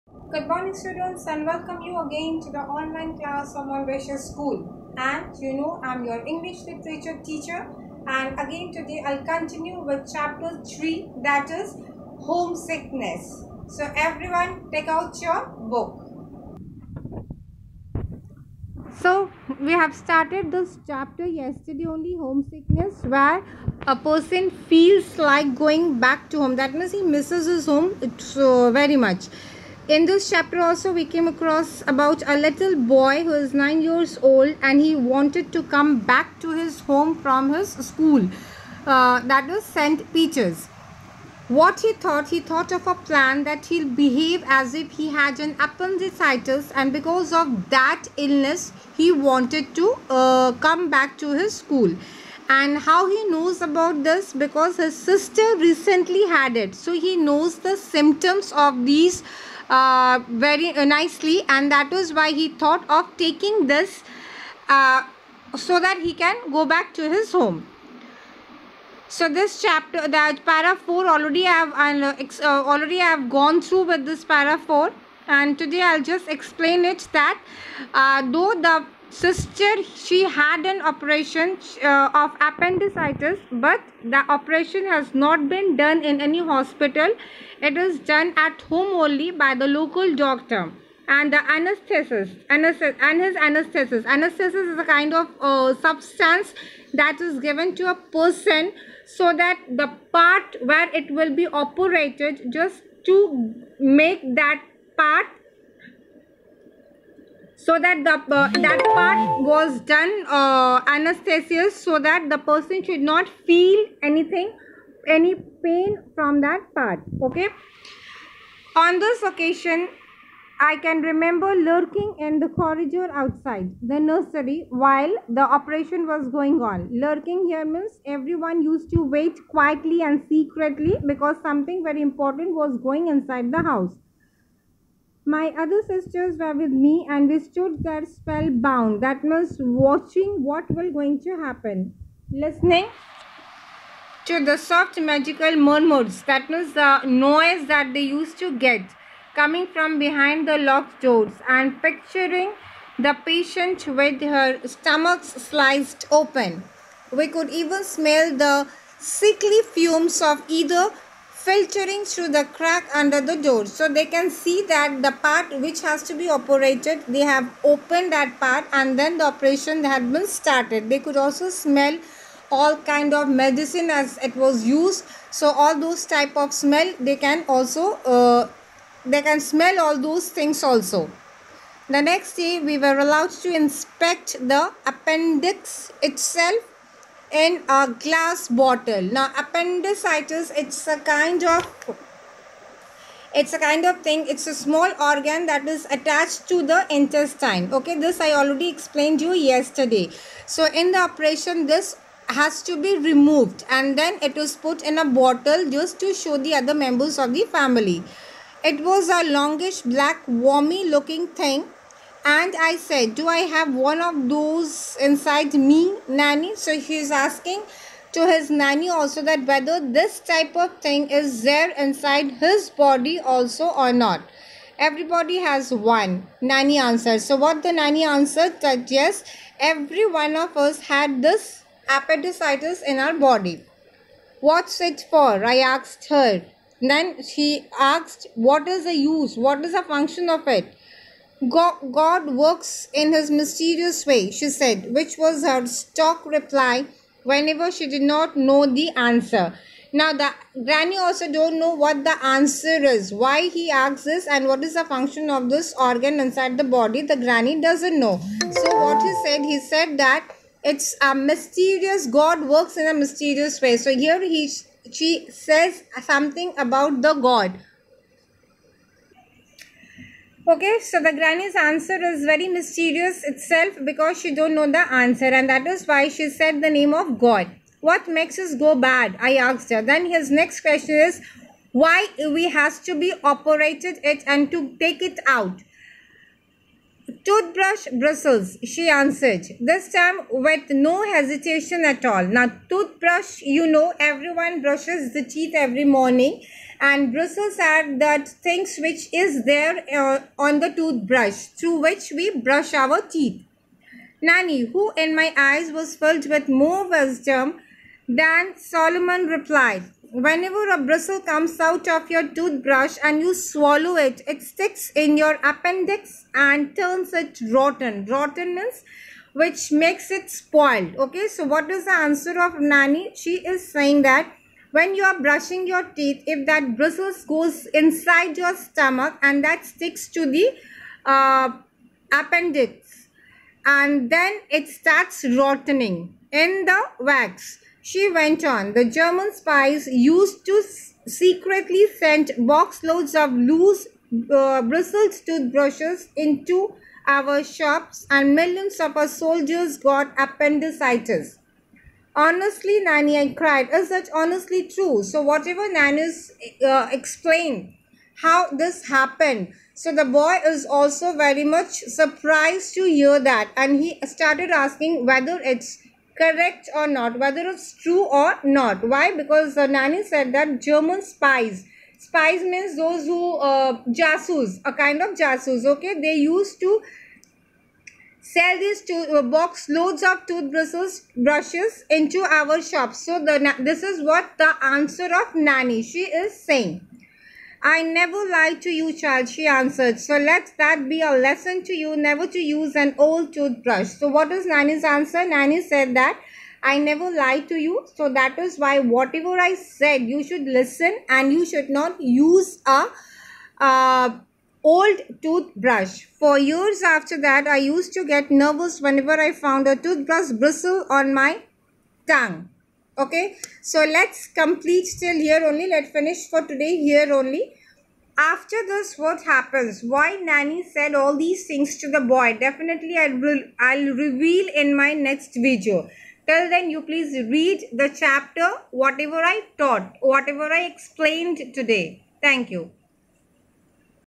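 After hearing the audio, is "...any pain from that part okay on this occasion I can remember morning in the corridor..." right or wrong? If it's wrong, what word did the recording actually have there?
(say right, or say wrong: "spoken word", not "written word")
wrong: "lurking", not "morning".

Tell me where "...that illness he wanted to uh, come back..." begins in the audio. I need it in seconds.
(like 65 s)
47 s.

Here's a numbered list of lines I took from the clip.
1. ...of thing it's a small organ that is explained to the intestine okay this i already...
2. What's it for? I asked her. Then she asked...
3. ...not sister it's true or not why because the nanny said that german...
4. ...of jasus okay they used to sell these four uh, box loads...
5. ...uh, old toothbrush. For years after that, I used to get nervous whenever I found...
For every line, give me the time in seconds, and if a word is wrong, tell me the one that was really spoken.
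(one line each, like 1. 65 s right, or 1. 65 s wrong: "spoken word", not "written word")
1. 193 s wrong: "attached", not "explained"
2. 234 s right
3. 366 s wrong: "whether", not "sister"
4. 375 s wrong: "two", not "four"
5. 403 s right.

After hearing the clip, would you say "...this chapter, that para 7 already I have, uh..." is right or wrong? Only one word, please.
wrong.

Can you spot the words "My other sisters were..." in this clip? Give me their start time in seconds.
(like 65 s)
135 s.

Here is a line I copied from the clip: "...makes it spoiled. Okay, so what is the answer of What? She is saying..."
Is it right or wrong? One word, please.
wrong.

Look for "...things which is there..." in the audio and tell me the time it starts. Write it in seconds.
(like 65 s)
298 s.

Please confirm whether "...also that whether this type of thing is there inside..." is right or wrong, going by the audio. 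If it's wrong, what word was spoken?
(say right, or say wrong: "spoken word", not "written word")
right.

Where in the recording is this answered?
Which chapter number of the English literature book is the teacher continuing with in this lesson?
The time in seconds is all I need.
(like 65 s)
10 s.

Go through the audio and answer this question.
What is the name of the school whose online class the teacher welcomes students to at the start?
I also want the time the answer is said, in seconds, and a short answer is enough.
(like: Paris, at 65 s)
Montbretia School, at 3 s.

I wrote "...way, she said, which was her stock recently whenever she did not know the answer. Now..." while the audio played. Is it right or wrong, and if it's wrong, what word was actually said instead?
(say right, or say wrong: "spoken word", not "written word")
wrong: "reply", not "recently".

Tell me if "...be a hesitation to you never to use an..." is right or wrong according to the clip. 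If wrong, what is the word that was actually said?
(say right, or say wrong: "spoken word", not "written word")
wrong: "lesson", not "hesitation".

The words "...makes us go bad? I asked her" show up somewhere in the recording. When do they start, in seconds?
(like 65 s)
278 s.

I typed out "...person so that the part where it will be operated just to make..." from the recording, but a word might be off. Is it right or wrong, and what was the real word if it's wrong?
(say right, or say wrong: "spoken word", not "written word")
right.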